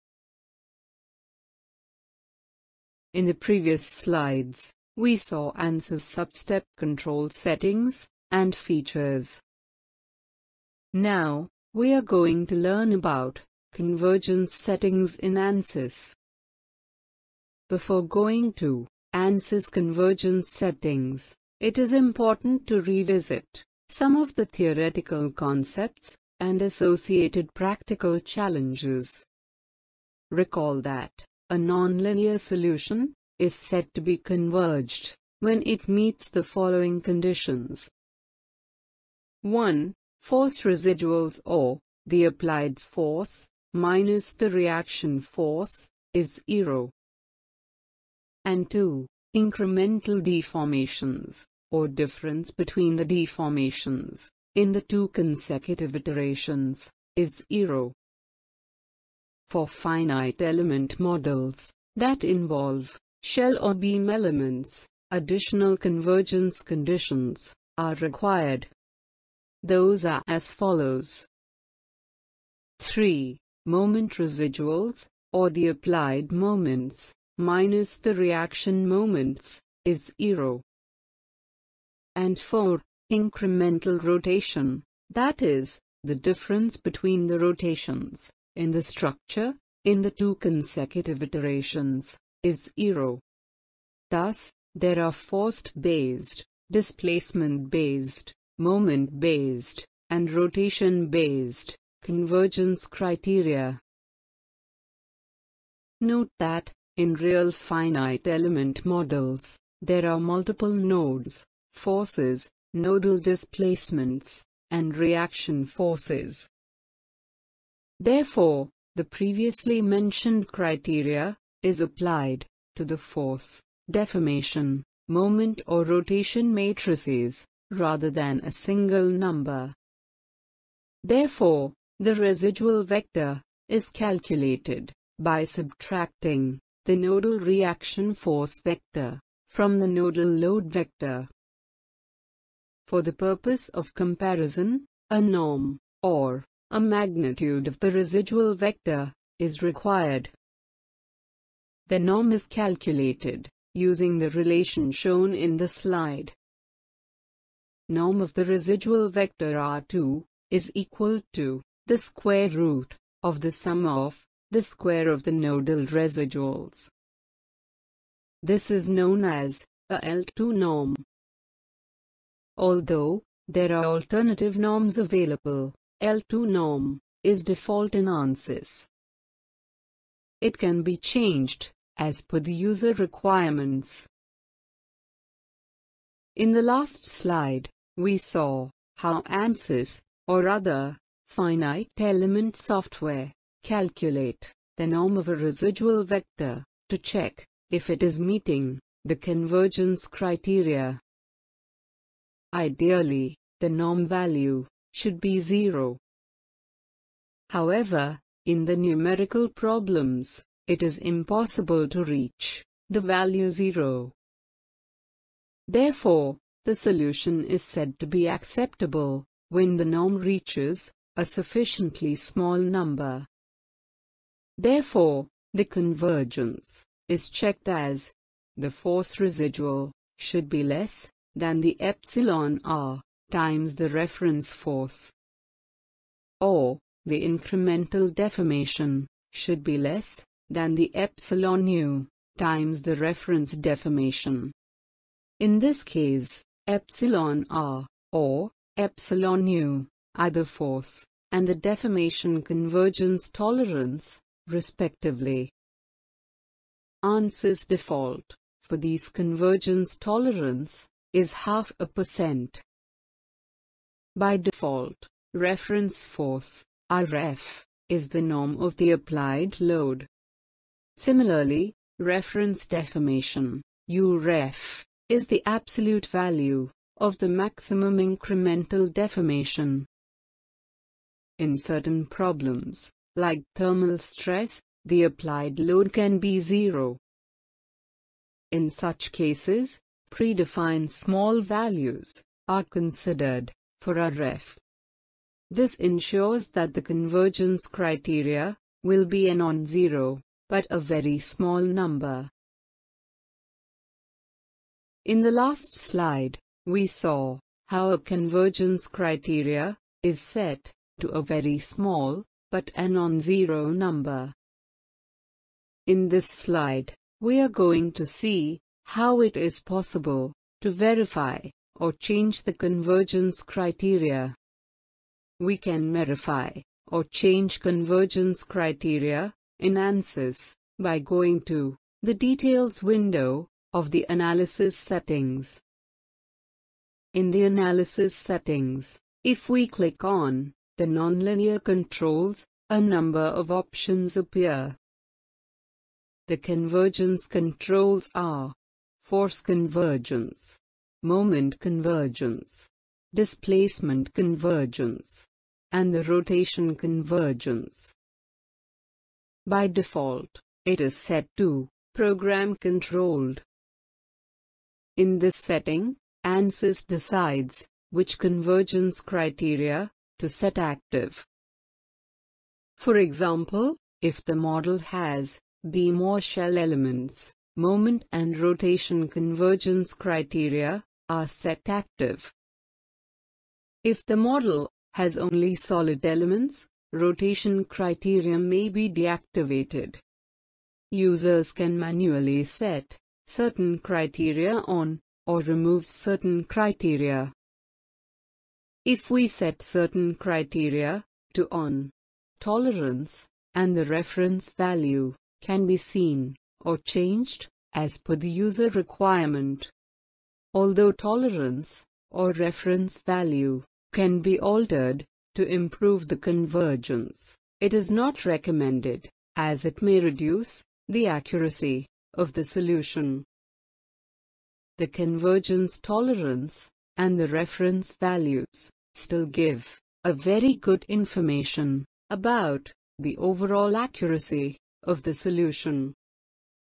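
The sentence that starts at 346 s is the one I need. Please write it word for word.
The convergence controls are force convergence, moment convergence, displacement convergence, and the rotation convergence.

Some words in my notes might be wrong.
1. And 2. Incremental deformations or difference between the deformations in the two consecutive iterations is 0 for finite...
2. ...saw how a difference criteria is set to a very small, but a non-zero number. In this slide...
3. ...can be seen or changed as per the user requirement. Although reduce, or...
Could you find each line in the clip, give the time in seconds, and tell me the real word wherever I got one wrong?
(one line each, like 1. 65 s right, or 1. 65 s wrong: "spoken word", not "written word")
1. 48 s right
2. 306 s wrong: "convergence", not "difference"
3. 405 s wrong: "tolerance", not "reduce".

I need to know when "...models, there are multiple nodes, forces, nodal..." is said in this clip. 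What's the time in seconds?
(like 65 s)
108 s.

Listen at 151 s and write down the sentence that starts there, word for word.
The norm is calculated, using the relation shown in the slide.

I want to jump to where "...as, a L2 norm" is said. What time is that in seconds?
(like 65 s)
169 s.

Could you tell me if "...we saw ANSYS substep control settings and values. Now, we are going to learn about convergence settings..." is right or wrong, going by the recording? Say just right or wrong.
wrong.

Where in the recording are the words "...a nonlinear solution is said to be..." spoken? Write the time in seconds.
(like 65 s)
31 s.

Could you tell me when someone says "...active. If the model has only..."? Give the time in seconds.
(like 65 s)
381 s.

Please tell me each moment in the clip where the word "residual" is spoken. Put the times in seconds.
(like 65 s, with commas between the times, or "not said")
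40 s, 74 s, 132 s, 147 s, 158 s, 165 s, 195 s, 229 s.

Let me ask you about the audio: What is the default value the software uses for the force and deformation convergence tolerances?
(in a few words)
half a percent.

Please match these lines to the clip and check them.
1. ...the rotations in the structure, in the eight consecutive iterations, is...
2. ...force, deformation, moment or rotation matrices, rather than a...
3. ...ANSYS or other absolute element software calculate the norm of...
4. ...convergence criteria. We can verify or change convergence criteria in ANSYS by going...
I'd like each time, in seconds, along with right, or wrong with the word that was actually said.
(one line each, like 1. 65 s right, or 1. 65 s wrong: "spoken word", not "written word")
1. 87 s wrong: "two", not "eight"
2. 122 s right
3. 189 s wrong: "finite", not "absolute"
4. 322 s right.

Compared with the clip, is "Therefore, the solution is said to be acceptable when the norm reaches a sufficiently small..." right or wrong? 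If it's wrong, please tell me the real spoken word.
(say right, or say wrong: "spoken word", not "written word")
right.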